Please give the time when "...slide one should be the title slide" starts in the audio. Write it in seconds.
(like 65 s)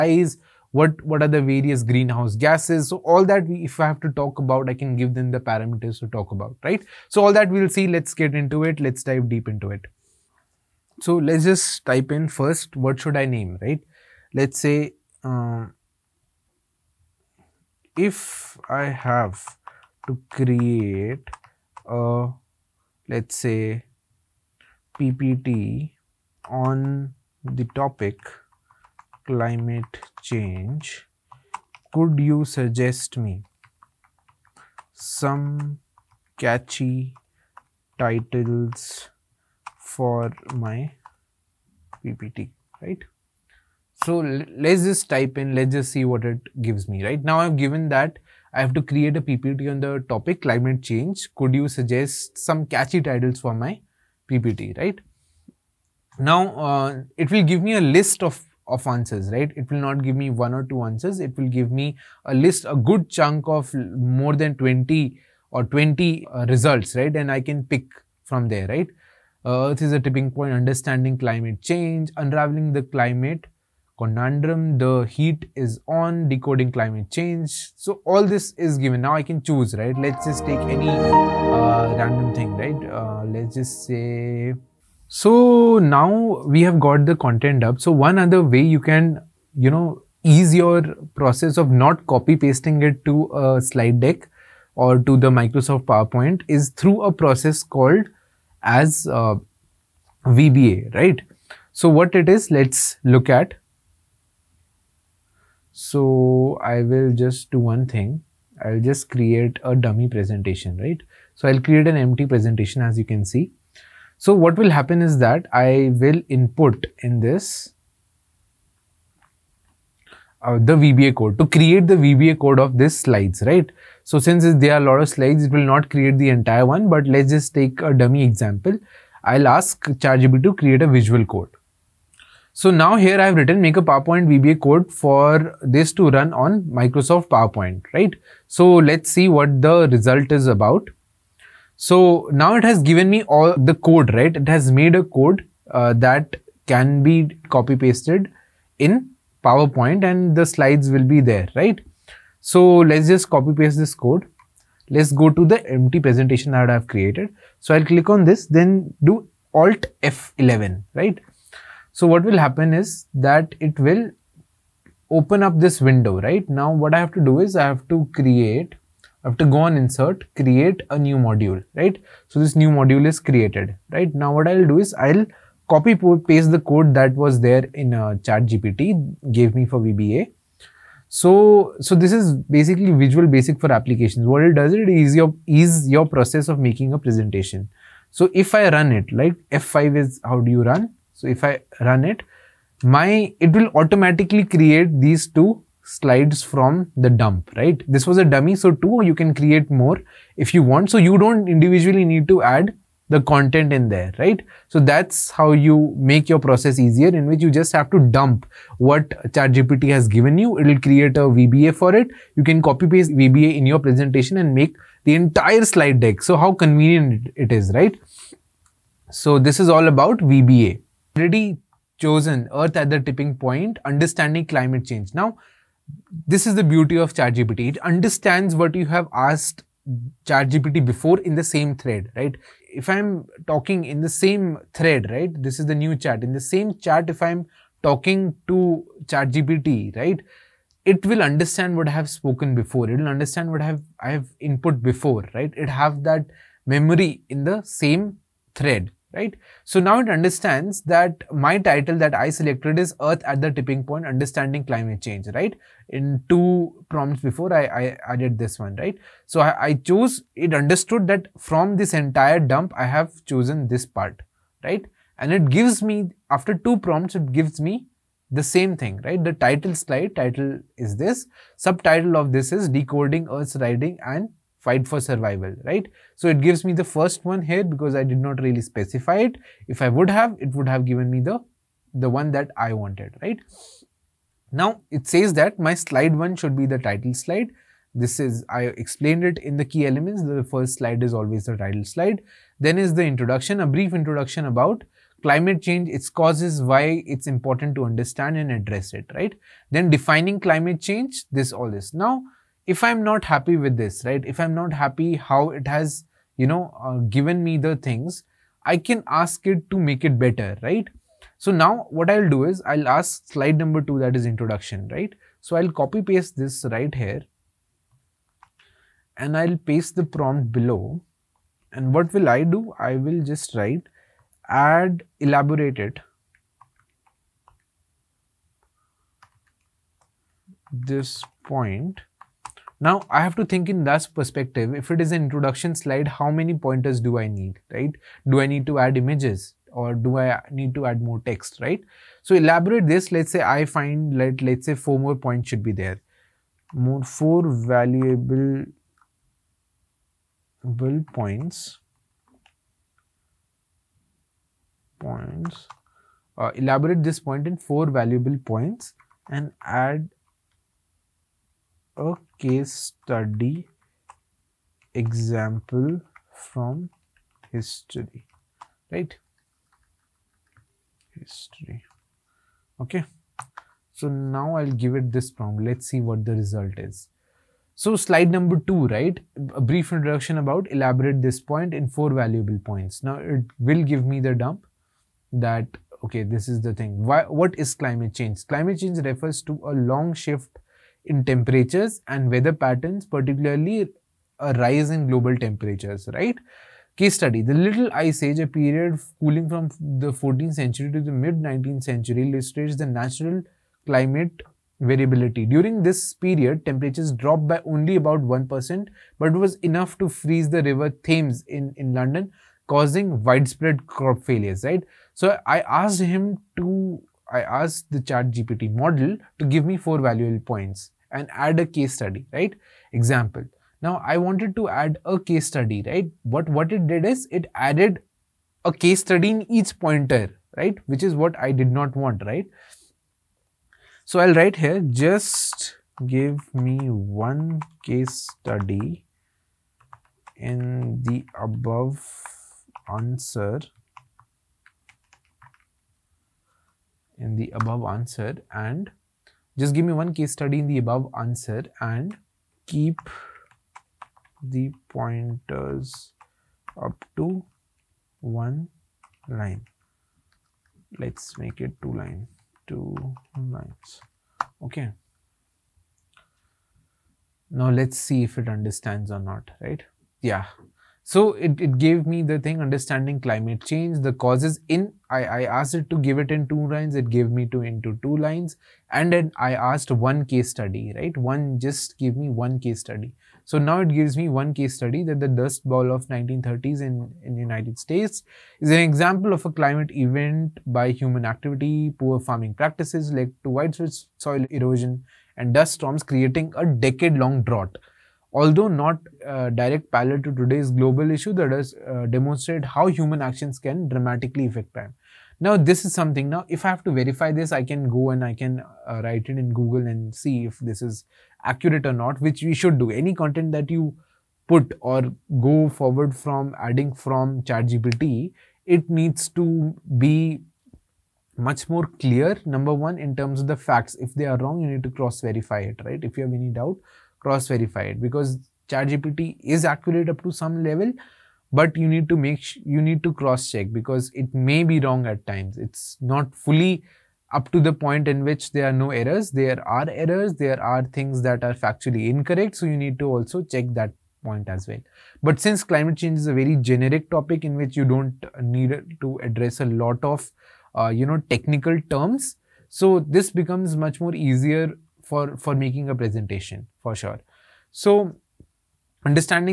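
285 s.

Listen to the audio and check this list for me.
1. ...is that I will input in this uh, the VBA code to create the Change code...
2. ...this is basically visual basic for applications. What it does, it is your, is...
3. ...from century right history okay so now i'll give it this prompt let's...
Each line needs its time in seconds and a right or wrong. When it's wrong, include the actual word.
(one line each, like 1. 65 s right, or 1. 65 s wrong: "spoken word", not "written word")
1. 115 s wrong: "VBA", not "Change"
2. 181 s right
3. 366 s wrong: "history", not "century".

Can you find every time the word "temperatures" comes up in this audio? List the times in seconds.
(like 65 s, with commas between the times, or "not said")
391 s, 395 s, 406 s.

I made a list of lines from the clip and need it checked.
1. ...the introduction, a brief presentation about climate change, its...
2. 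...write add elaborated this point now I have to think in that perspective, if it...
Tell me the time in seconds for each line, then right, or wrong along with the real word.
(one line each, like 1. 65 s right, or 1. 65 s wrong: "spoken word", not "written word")
1. 292 s wrong: "introduction", not "presentation"
2. 323 s right.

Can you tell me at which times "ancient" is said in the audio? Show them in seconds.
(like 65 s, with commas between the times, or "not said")
not said.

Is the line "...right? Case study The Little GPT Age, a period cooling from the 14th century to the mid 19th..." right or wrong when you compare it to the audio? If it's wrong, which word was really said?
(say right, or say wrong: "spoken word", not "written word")
wrong: "Ice", not "GPT".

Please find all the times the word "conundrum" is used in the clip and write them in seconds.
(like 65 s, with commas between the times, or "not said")
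73 s.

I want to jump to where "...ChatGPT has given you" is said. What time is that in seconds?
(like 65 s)
209 s.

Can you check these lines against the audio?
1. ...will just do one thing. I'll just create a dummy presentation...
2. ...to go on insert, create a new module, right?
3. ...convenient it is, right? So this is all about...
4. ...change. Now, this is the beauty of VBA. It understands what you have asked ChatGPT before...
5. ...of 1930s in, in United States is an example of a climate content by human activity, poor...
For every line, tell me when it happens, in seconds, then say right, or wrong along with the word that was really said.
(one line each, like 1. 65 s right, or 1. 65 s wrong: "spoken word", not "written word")
1. 106 s right
2. 169 s right
3. 216 s right
4. 224 s wrong: "ChatGPT", not "VBA"
5. 485 s wrong: "event", not "content".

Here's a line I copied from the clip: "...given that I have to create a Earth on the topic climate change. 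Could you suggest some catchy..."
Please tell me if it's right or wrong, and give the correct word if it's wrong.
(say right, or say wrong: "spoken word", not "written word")
wrong: "PPT", not "Earth".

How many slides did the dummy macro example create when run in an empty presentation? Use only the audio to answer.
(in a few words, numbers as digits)
2.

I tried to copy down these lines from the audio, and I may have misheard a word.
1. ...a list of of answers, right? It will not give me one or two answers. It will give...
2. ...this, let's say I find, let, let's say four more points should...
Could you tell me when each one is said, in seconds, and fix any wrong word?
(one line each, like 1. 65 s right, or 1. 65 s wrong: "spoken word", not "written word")
1. 57 s right
2. 342 s right.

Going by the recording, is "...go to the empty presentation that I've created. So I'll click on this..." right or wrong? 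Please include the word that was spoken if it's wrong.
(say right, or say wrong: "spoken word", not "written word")
right.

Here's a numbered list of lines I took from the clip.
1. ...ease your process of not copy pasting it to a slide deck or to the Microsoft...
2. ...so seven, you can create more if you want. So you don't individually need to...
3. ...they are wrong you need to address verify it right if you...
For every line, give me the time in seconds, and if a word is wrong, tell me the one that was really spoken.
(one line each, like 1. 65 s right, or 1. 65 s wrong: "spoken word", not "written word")
1. 90 s right
2. 198 s wrong: "two", not "seven"
3. 524 s wrong: "cross", not "address".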